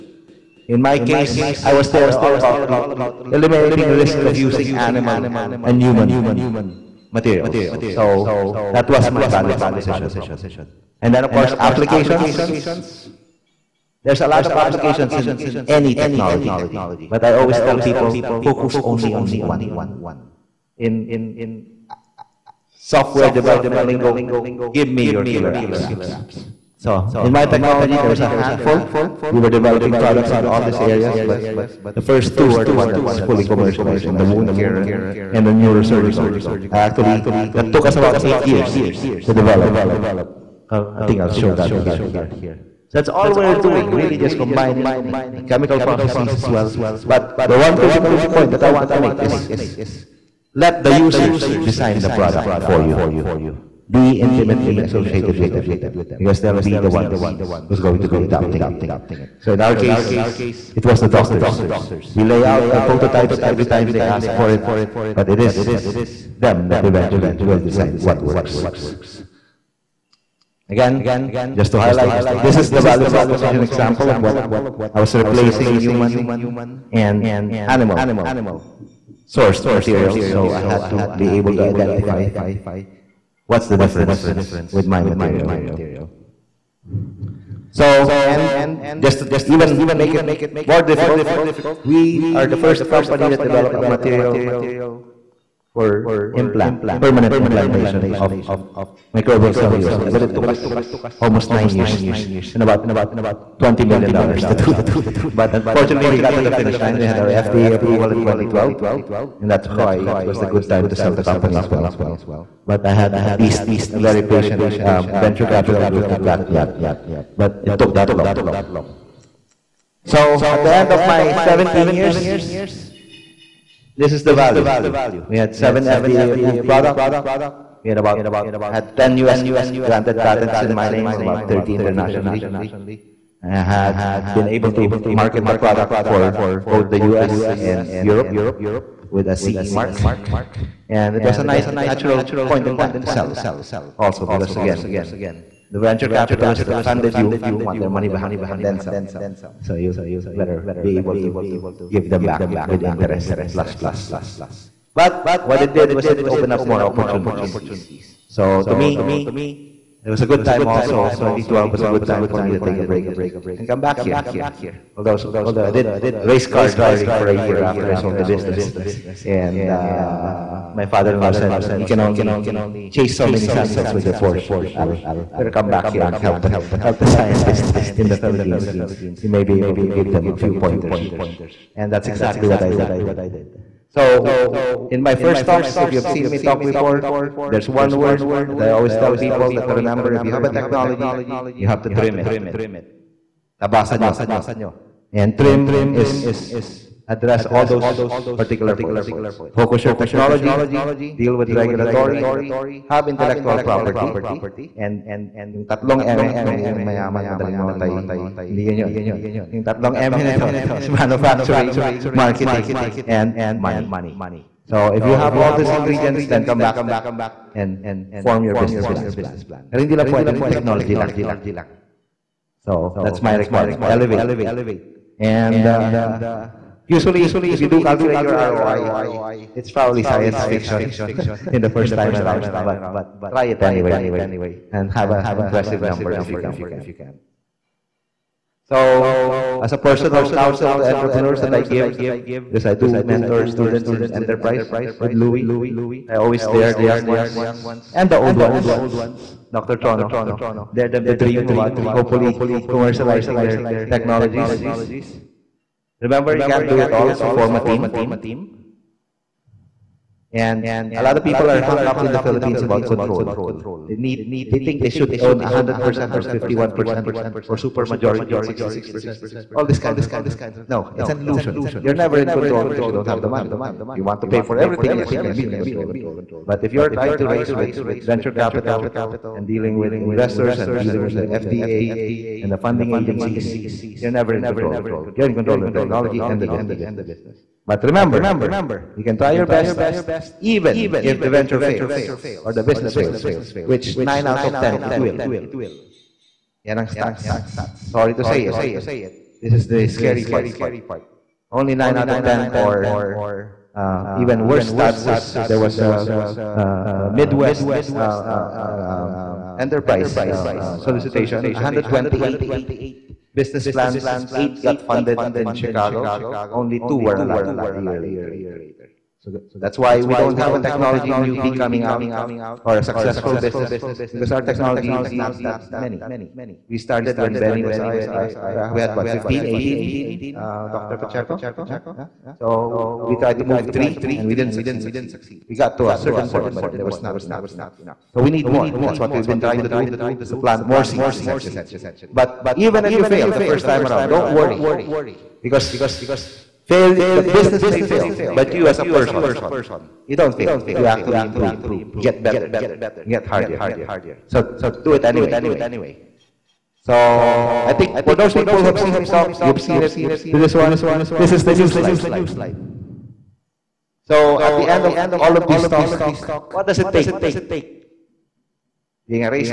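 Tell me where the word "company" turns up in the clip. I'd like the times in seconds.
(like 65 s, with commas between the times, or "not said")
92 s, 111 s.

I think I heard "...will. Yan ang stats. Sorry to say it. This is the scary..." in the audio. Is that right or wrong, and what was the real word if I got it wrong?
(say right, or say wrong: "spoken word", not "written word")
right.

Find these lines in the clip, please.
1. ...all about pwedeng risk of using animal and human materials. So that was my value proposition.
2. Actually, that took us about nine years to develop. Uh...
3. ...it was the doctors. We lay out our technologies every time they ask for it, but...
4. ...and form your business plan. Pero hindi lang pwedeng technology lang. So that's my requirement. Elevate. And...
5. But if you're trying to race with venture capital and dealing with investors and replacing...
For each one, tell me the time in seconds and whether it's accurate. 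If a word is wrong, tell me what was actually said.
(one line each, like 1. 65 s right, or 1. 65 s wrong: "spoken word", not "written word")
1. 2 s wrong: "eliminating", not "pwedeng"
2. 36 s wrong: "eight", not "nine"
3. 60 s wrong: "prototypes", not "technologies"
4. 217 s right
5. 276 s wrong: "dealing", not "replacing".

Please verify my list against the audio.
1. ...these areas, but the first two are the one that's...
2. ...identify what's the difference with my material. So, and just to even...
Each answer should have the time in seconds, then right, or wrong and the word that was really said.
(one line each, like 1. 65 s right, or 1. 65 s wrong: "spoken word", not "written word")
1. 30 s right
2. 81 s right.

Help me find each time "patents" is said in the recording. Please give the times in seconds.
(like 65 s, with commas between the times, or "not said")
130 s.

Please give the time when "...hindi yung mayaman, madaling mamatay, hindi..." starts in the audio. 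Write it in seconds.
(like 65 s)
206 s.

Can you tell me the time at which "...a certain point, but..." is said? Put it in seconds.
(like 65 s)
335 s.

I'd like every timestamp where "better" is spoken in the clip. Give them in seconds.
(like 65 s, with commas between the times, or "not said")
150 s, 175 s, 352 s.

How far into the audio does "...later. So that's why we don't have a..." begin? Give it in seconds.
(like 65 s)
317 s.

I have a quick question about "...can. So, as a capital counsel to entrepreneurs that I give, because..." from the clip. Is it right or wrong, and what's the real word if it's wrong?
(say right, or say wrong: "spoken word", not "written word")
wrong: "personal", not "capital".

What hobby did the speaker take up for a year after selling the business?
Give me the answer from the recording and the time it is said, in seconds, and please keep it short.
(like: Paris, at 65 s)
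race car driving, at 166 s.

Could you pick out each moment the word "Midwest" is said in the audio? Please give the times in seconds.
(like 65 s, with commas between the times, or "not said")
307 s.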